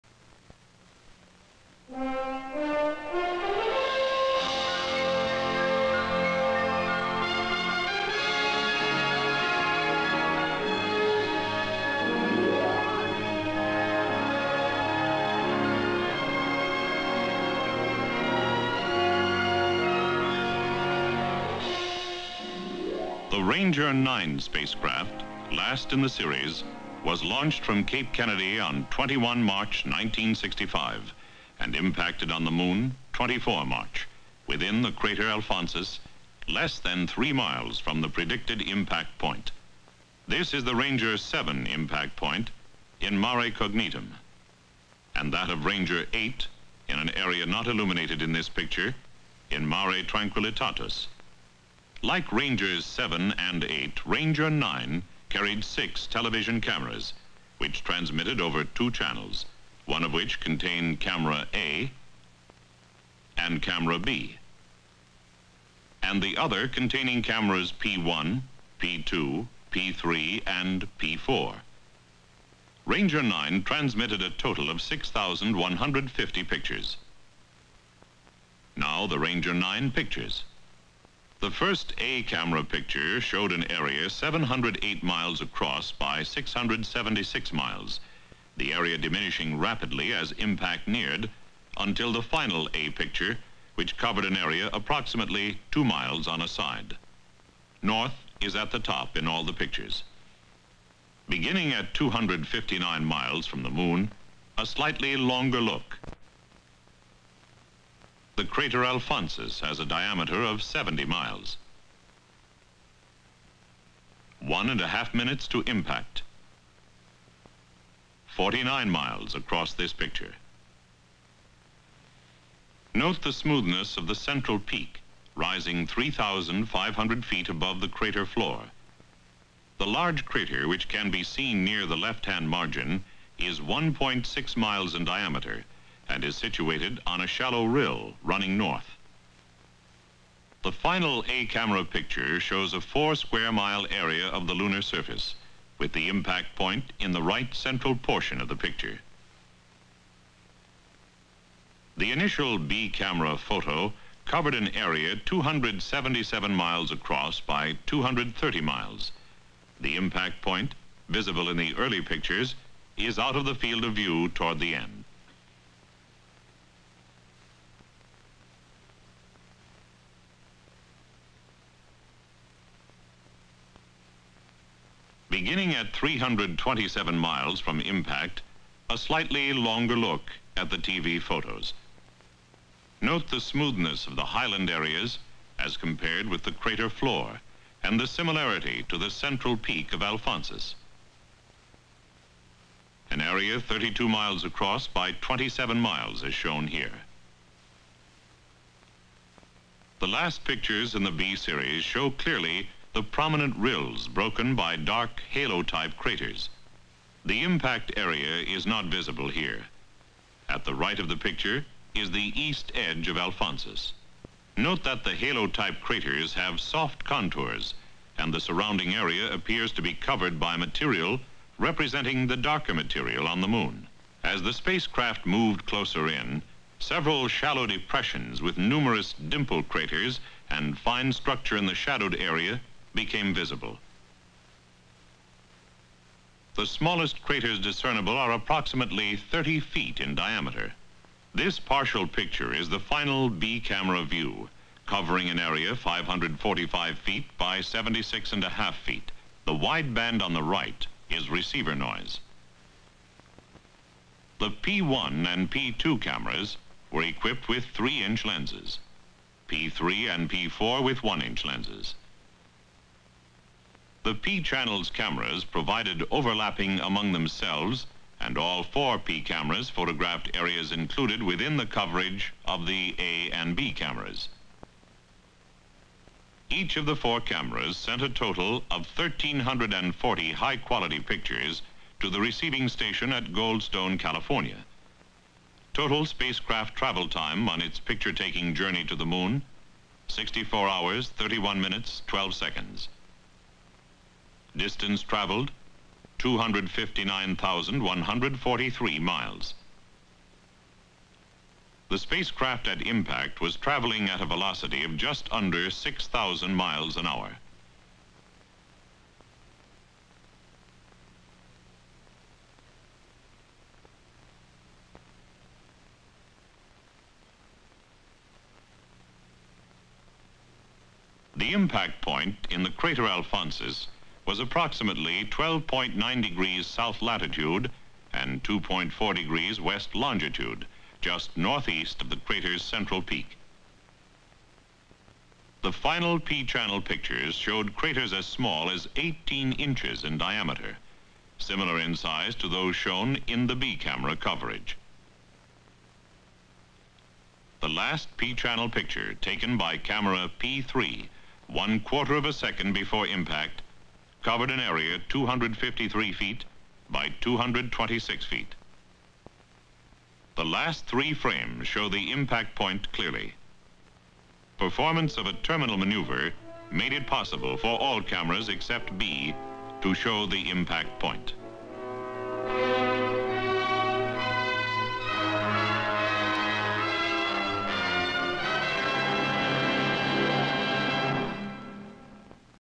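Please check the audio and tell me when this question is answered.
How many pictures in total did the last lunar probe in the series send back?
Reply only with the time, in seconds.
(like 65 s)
74 s.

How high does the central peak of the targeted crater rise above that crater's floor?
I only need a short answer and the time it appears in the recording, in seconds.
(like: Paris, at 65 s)
3,500 feet, at 125 s.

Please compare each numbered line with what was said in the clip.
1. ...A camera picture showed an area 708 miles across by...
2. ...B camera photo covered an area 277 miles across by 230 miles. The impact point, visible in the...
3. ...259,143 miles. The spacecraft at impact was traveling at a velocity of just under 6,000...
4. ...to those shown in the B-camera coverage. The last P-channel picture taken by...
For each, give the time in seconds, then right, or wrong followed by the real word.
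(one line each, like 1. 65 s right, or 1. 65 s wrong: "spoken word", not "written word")
1. 81 s right
2. 152 s right
3. 296 s right
4. 342 s right.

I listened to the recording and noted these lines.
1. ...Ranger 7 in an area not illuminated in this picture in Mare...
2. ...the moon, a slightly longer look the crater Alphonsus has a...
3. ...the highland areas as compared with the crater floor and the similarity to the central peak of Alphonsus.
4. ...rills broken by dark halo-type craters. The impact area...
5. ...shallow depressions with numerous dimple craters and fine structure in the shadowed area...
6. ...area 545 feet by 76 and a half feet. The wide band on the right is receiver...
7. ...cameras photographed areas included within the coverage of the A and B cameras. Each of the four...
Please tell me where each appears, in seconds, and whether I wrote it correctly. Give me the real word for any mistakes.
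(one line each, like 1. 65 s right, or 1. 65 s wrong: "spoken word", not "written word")
1. 45 s wrong: "8", not "7"
2. 103 s right
3. 184 s right
4. 203 s right
5. 227 s right
6. 245 s right
7. 269 s right.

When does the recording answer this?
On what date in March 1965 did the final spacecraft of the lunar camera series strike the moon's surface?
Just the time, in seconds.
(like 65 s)
33 s.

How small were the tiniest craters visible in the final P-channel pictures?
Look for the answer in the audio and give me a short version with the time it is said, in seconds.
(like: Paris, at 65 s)
18 inches, at 338 s.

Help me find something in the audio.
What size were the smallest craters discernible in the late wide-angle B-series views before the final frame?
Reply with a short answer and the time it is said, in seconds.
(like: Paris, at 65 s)
30 feet, at 239 s.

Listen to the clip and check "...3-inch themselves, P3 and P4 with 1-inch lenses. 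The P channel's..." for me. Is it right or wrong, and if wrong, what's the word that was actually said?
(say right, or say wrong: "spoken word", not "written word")
wrong: "lenses", not "themselves".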